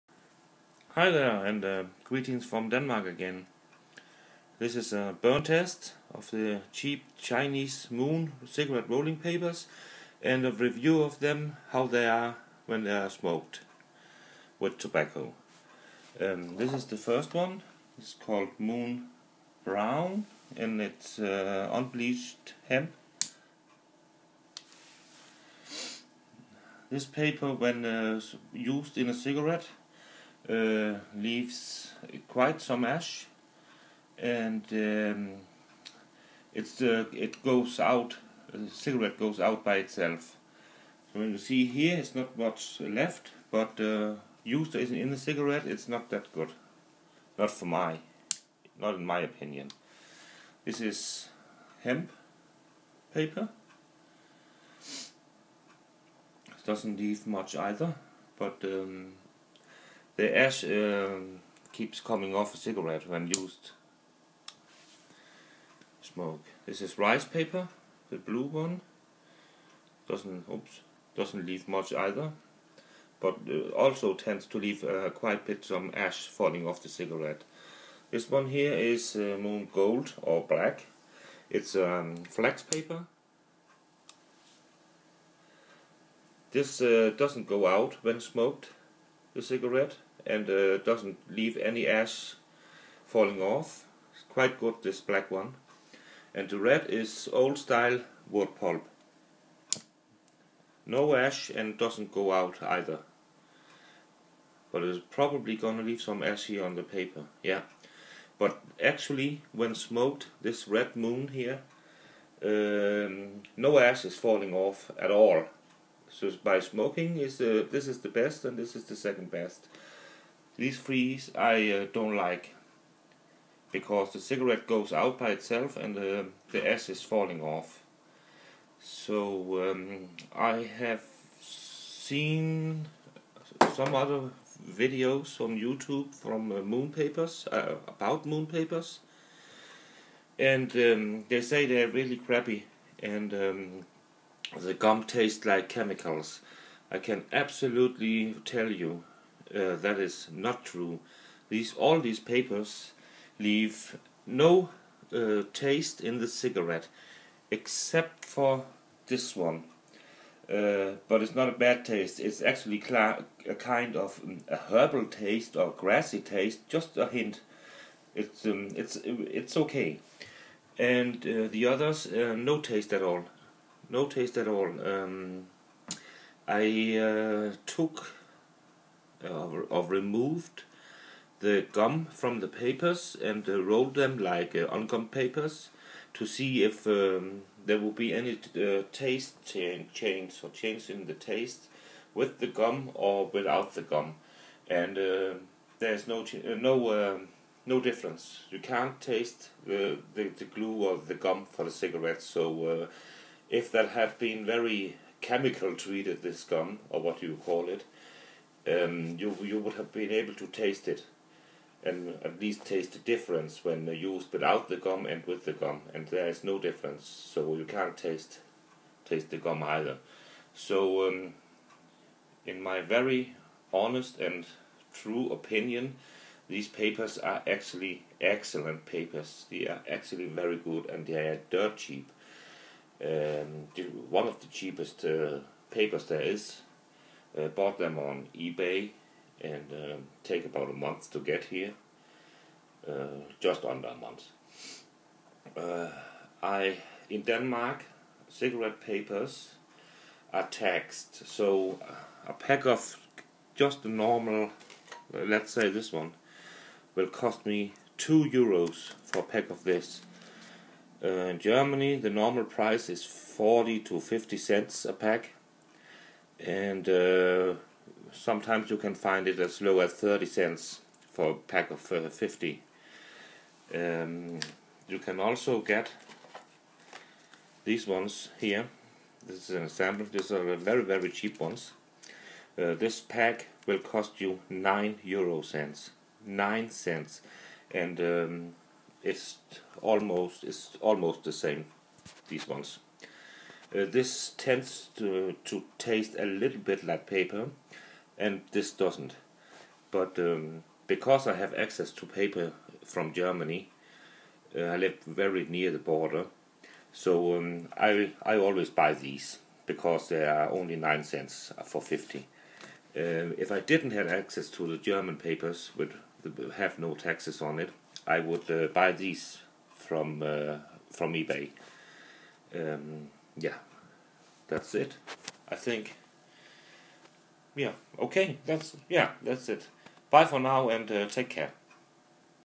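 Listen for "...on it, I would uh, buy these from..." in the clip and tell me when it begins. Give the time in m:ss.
5:17.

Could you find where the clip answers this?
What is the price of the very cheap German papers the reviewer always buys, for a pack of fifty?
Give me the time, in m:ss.
4:44.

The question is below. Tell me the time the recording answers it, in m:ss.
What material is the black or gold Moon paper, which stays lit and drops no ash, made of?
1:22.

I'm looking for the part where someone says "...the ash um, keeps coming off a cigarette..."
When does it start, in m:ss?
1:00.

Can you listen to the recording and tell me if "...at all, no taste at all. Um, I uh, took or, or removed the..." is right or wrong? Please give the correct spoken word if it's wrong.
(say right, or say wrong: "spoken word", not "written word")
right.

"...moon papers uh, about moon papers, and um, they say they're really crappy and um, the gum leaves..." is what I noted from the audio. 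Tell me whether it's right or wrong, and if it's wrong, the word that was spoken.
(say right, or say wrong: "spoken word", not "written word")
wrong: "tastes", not "leaves".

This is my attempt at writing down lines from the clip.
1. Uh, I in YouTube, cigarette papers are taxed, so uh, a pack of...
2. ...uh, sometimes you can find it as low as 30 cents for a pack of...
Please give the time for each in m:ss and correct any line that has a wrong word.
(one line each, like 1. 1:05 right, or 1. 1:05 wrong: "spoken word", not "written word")
1. 4:05 wrong: "Denmark", not "YouTube"
2. 4:26 right.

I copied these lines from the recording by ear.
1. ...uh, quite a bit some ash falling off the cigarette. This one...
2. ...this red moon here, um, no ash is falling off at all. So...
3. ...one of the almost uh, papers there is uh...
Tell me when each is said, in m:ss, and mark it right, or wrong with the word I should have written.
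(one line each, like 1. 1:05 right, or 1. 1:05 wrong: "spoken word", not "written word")
1. 1:14 right
2. 1:50 right
3. 3:54 wrong: "cheapest", not "almost".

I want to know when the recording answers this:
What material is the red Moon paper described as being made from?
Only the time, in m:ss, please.
1:37.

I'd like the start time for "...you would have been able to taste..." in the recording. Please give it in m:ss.
3:29.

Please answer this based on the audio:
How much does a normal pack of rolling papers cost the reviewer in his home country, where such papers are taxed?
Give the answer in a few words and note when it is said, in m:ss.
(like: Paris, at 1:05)
2 euros, at 4:17.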